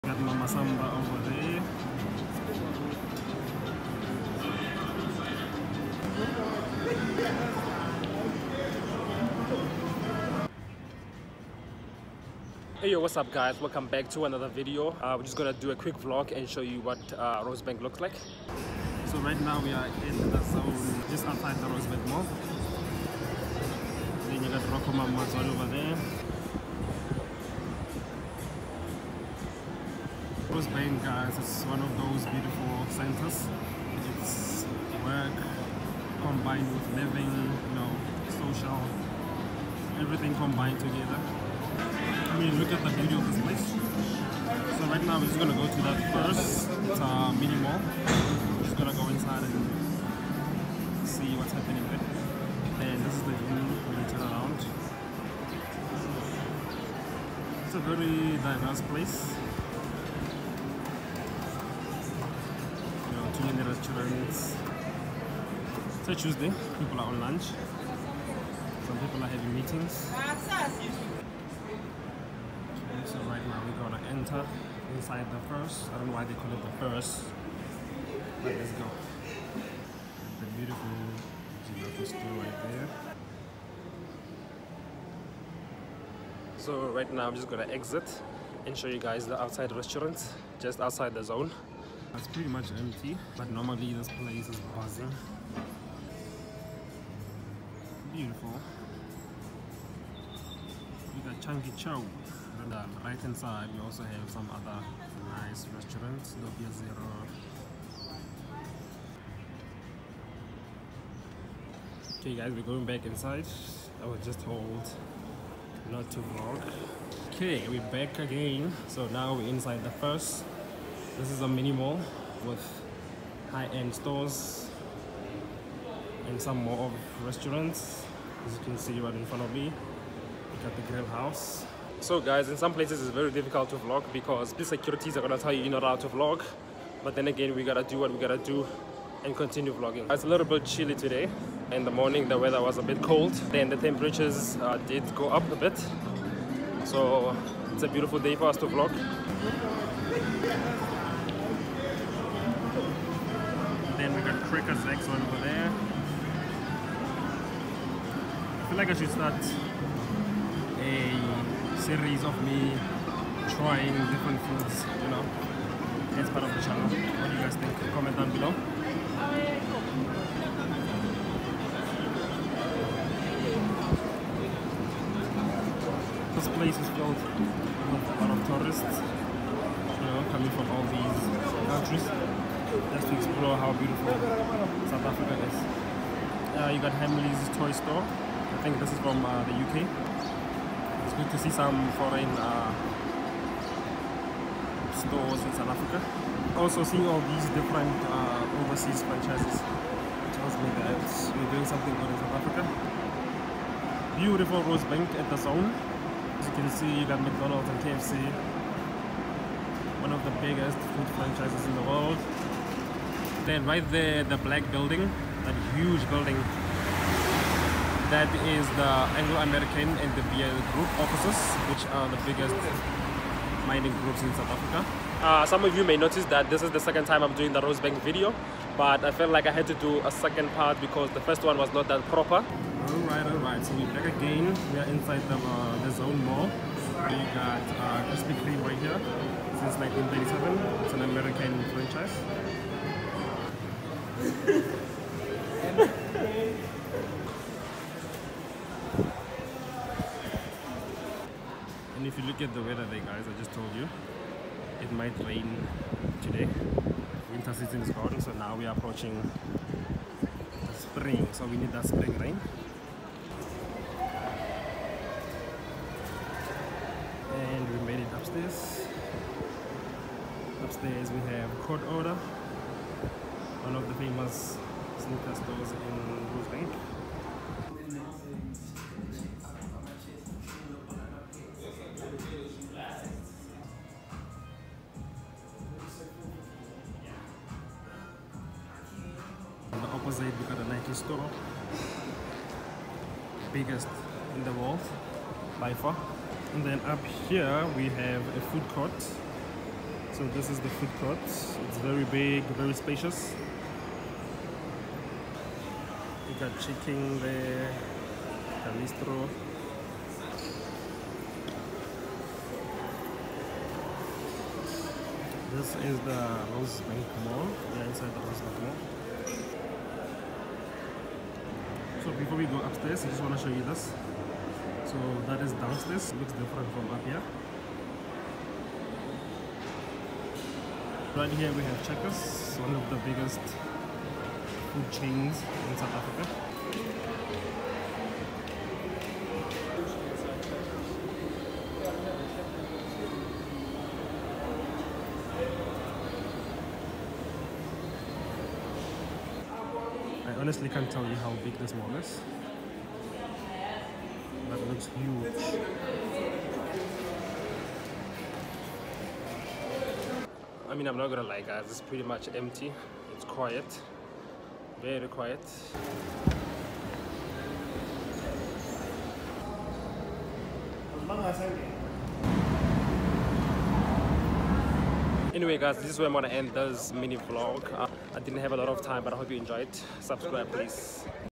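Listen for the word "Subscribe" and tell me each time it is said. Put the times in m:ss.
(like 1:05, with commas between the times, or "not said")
6:19.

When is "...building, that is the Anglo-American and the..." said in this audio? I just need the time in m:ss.
3:36.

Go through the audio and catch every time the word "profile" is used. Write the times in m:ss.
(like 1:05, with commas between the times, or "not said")
not said.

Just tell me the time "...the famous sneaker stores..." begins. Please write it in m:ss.
4:33.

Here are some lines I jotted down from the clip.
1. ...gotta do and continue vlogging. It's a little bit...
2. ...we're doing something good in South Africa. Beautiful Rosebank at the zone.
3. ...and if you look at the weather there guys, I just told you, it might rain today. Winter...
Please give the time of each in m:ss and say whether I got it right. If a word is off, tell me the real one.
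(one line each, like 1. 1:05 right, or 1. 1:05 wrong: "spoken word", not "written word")
1. 2:18 right
2. 3:21 right
3. 4:04 right.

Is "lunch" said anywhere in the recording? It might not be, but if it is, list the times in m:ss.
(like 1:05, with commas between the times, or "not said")
1:07.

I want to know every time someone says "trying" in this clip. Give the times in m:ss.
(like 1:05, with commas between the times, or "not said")
2:43.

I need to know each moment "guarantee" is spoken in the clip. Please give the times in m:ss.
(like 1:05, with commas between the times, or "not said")
not said.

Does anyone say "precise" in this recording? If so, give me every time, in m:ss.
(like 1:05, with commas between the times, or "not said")
not said.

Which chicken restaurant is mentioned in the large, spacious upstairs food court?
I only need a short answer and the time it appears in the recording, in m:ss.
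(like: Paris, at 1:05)
Galito's, at 5:08.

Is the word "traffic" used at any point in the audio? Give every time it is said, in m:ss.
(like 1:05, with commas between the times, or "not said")
not said.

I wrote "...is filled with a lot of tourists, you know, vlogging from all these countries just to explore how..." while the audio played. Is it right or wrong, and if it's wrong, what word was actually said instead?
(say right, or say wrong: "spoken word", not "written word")
wrong: "coming", not "vlogging".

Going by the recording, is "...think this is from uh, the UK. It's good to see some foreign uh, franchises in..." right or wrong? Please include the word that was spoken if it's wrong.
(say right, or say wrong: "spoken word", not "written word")
wrong: "stores", not "franchises".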